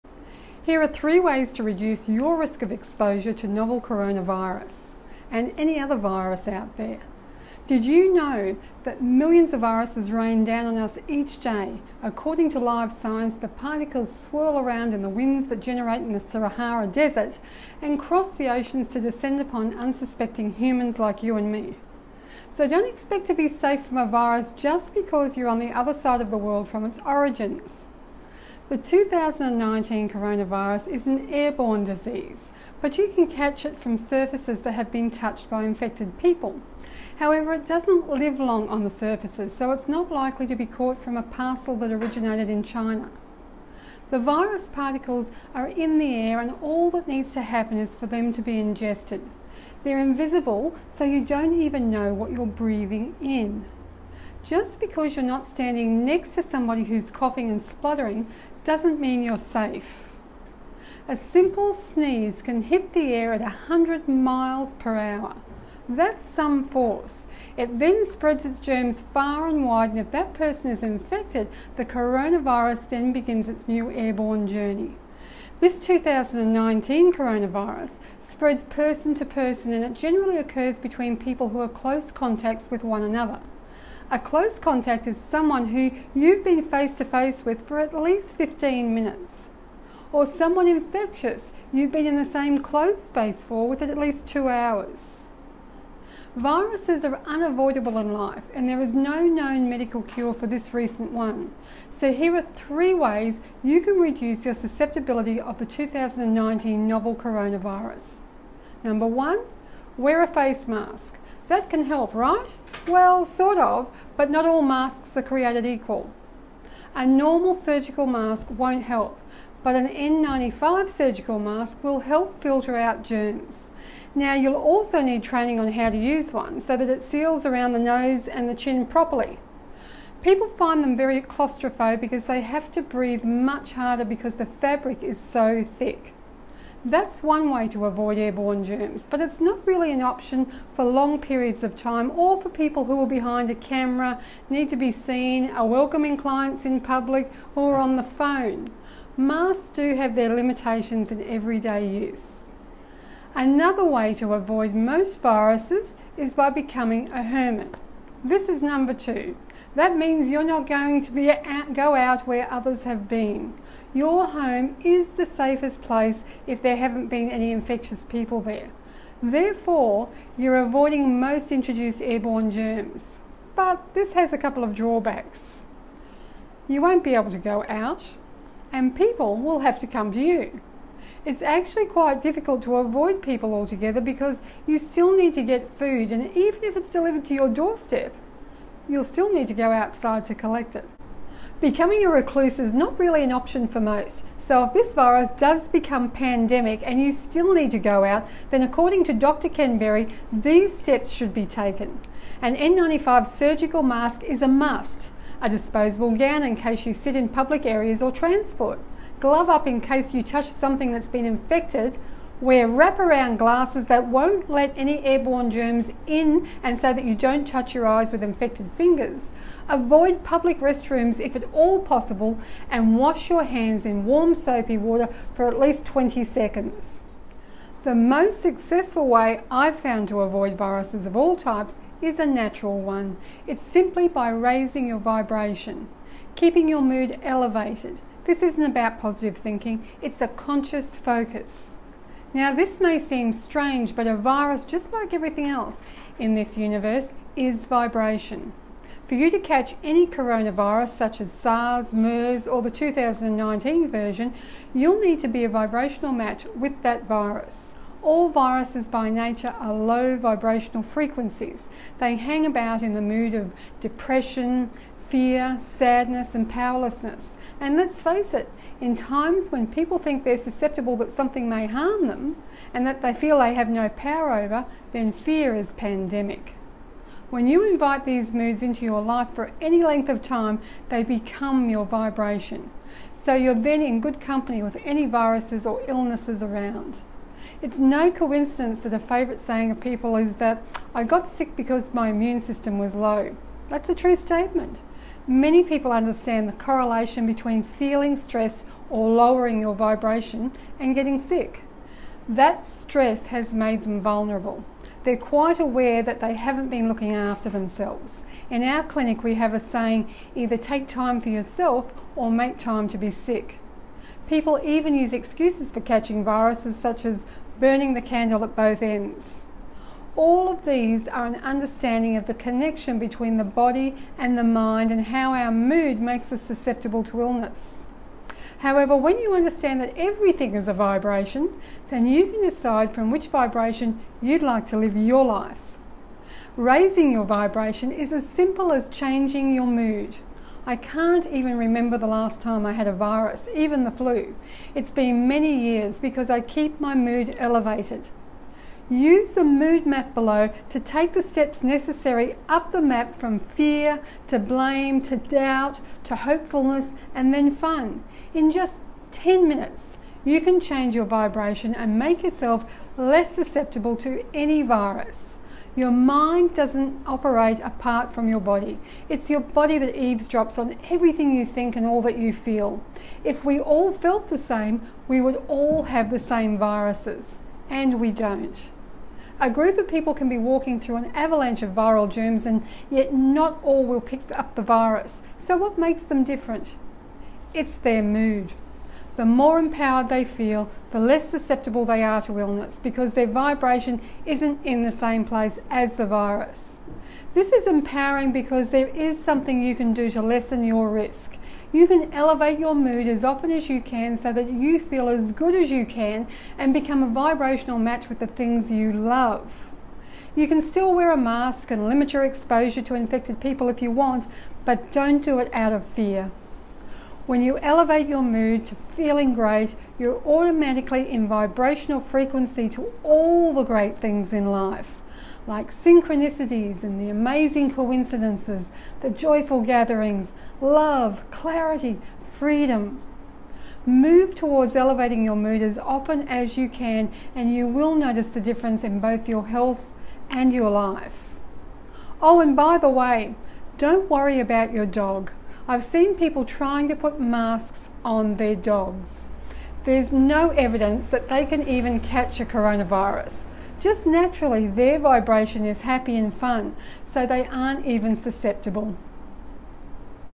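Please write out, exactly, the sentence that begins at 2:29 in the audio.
Masks do have their limitations in everyday use.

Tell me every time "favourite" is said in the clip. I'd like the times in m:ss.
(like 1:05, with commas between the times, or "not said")
4:48.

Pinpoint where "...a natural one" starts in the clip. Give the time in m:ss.
3:52.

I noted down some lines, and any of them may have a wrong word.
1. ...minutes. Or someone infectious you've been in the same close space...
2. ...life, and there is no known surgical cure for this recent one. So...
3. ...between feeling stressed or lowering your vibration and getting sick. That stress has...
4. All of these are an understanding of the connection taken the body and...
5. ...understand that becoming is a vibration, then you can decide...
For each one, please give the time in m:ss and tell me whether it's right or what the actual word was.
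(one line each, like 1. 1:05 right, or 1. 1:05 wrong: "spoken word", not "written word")
1. 1:28 right
2. 1:38 wrong: "medical", not "surgical"
3. 4:57 right
4. 5:20 wrong: "between", not "taken"
5. 5:29 wrong: "everything", not "becoming".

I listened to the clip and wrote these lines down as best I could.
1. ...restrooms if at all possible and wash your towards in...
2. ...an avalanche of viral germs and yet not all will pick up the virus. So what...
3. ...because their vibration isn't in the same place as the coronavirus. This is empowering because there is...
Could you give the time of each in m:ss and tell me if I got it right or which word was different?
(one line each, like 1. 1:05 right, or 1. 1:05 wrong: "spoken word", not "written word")
1. 3:40 wrong: "hands", not "towards"
2. 6:20 right
3. 6:32 wrong: "virus", not "coronavirus".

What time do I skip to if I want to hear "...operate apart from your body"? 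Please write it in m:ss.
6:07.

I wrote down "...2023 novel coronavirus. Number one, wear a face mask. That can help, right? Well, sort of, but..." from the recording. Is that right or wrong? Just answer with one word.
wrong.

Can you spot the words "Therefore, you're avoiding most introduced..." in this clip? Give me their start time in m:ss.
2:49.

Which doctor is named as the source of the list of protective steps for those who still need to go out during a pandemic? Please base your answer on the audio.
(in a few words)
Dr. Berry.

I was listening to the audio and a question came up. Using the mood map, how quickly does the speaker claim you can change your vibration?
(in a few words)
10 minutes.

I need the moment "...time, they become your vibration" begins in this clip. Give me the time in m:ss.
4:40.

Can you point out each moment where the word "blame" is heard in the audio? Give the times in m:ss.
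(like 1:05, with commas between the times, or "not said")
5:54.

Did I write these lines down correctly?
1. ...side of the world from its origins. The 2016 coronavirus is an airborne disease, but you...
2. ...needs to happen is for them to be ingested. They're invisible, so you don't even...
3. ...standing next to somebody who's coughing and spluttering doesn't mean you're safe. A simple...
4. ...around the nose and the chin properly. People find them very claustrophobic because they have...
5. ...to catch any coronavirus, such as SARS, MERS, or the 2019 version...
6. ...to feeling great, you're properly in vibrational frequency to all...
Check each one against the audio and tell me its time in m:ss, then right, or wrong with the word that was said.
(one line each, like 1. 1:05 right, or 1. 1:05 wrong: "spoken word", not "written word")
1. 0:25 wrong: "2019", not "2016"
2. 0:47 right
3. 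0:55 right
4. 2:07 right
5. 4:09 right
6. 6:58 wrong: "automatically", not "properly".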